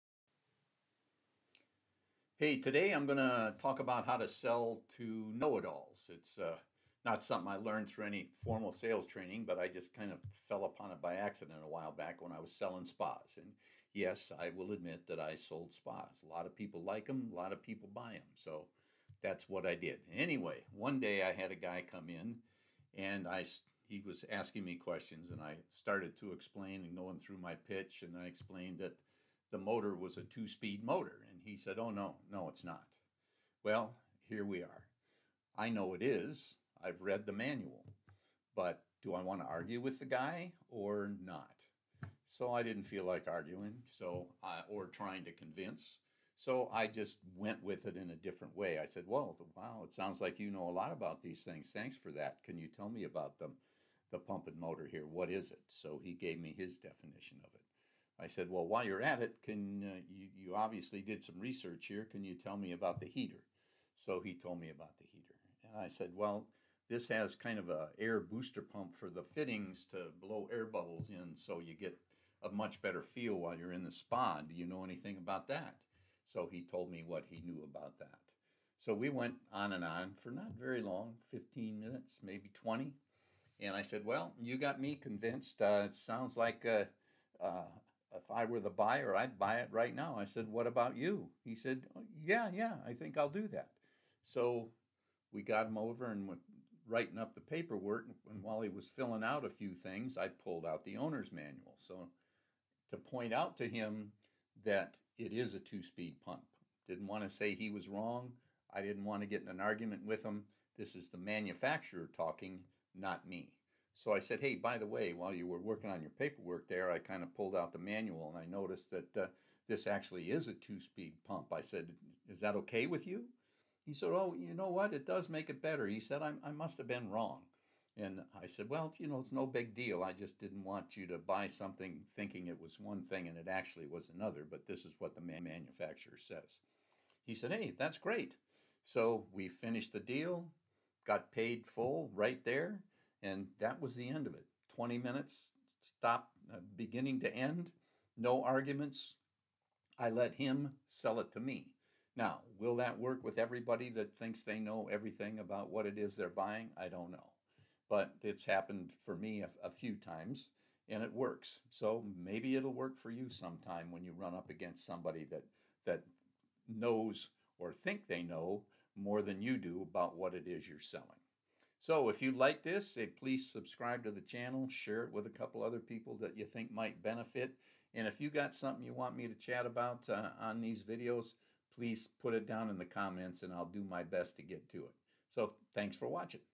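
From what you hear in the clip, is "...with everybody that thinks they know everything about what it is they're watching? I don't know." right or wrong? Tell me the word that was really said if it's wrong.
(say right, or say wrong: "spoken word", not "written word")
wrong: "buying", not "watching".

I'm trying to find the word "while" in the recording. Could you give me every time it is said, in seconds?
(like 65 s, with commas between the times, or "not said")
11 s, 58 s, 73 s, 98 s, 115 s.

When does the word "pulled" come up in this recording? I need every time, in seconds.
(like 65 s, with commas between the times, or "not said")
100 s, 117 s.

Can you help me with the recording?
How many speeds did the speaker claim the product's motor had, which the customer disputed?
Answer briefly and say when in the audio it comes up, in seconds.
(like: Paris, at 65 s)
2, at 30 s.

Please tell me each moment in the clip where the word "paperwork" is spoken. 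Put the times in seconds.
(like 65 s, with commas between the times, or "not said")
97 s, 116 s.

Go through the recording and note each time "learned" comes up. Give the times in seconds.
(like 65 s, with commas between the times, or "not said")
7 s.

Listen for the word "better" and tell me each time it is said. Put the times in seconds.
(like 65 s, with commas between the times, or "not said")
72 s, 125 s.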